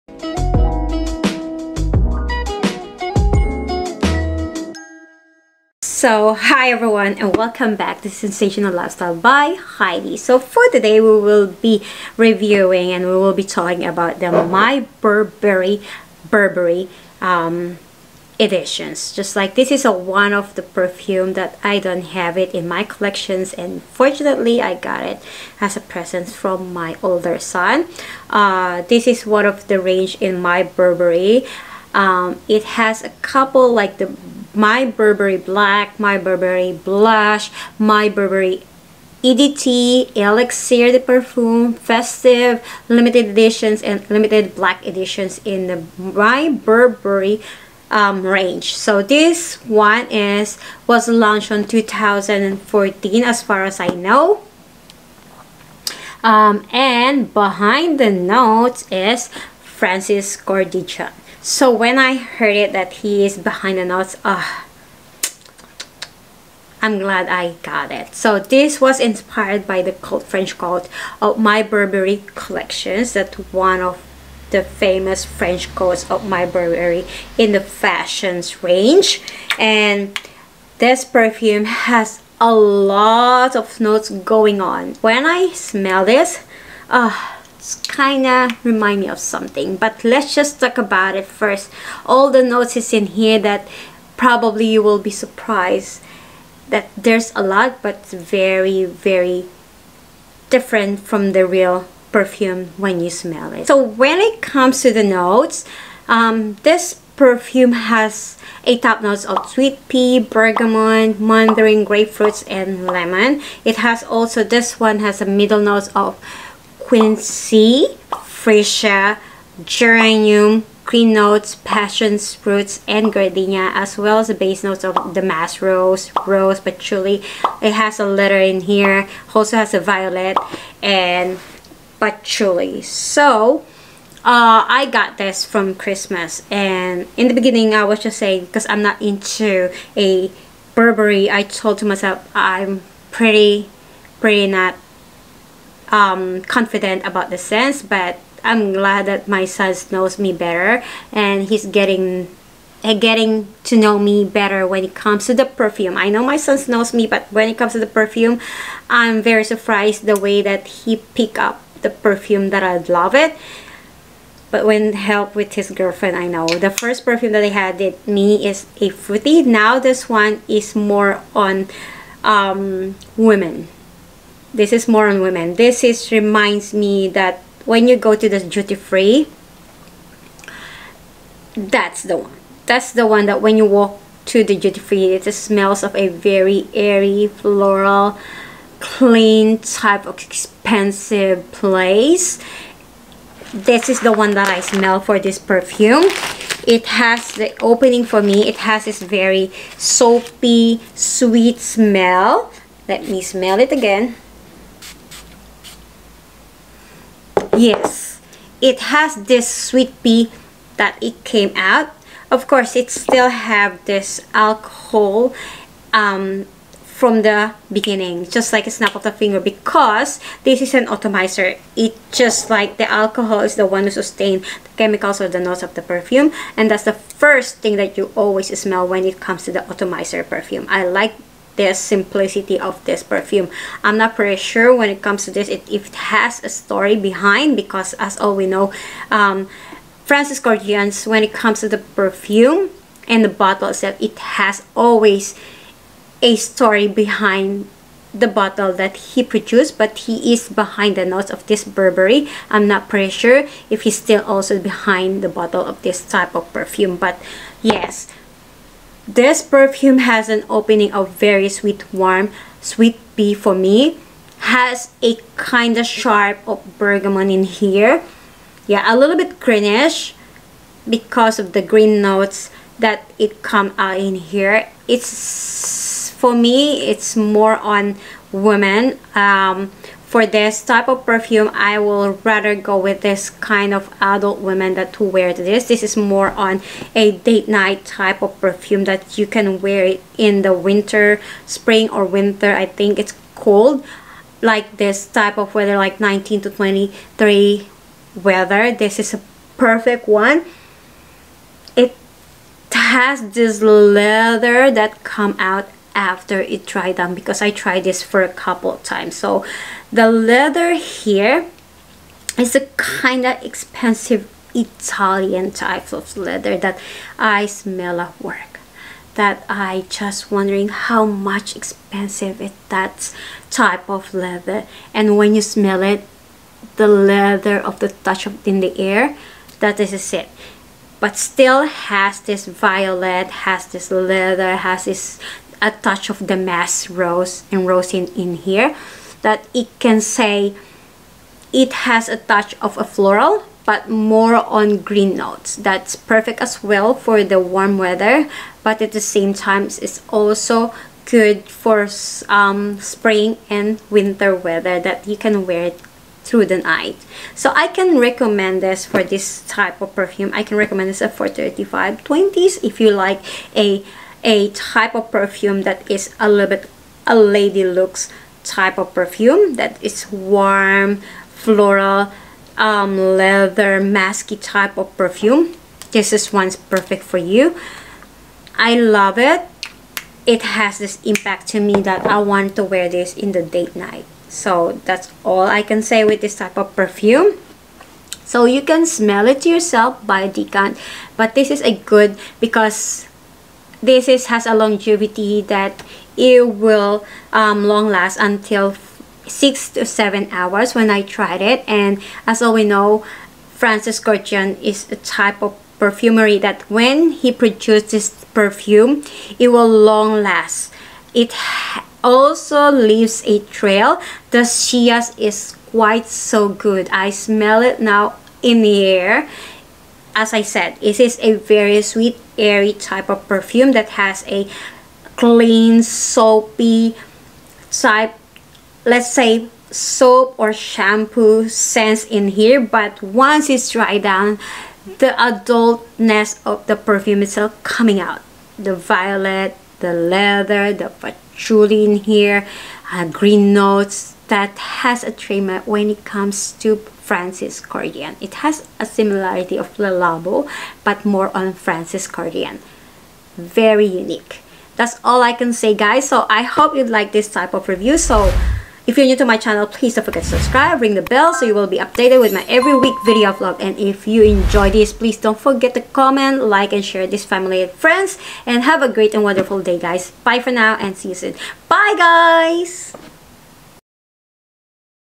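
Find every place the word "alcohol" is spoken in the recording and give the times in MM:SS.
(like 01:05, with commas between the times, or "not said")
03:34, 03:42.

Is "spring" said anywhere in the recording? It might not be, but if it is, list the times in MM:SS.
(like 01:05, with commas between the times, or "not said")
04:51, 05:52.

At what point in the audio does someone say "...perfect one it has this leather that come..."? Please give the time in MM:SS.
04:59.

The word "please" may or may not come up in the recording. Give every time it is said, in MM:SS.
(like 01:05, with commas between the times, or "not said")
07:39, 07:44.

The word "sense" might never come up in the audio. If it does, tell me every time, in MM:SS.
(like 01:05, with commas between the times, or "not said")
02:27, 07:11.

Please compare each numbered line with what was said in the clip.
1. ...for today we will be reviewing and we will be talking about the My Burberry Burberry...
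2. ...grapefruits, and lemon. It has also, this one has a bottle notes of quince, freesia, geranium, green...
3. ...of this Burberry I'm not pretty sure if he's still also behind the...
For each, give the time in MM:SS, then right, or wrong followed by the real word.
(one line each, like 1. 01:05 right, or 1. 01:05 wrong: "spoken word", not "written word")
1. 00:10 right
2. 01:51 wrong: "middle", not "bottle"
3. 04:11 right.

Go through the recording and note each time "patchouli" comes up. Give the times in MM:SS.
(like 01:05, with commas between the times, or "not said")
02:06, 02:12, 07:20.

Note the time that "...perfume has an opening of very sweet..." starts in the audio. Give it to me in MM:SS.
04:19.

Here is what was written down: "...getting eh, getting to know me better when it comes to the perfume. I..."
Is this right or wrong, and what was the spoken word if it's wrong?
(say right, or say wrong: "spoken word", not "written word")
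right.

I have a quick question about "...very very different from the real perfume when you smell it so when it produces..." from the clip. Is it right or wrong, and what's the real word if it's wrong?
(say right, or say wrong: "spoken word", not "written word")
wrong: "comes", not "produces".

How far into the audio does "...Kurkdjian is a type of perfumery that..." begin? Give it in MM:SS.
06:43.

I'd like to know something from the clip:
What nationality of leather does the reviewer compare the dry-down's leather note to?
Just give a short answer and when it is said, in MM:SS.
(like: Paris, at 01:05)
Italian, at 05:14.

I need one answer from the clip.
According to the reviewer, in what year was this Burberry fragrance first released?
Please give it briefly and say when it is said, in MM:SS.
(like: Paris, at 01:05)
2014, at 00:51.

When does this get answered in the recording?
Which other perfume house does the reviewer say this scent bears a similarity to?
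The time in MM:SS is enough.
07:29.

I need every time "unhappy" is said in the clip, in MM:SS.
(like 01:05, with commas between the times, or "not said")
not said.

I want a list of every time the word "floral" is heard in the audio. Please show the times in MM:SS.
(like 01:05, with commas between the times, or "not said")
03:07, 05:42, 06:11.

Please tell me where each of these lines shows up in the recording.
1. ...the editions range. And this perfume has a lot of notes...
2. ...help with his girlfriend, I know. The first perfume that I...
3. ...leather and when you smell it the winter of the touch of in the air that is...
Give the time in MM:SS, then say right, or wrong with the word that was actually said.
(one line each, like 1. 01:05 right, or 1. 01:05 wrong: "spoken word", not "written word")
1. 01:17 wrong: "fashions", not "editions"
2. 02:44 right
3. 05:24 wrong: "leather", not "winter".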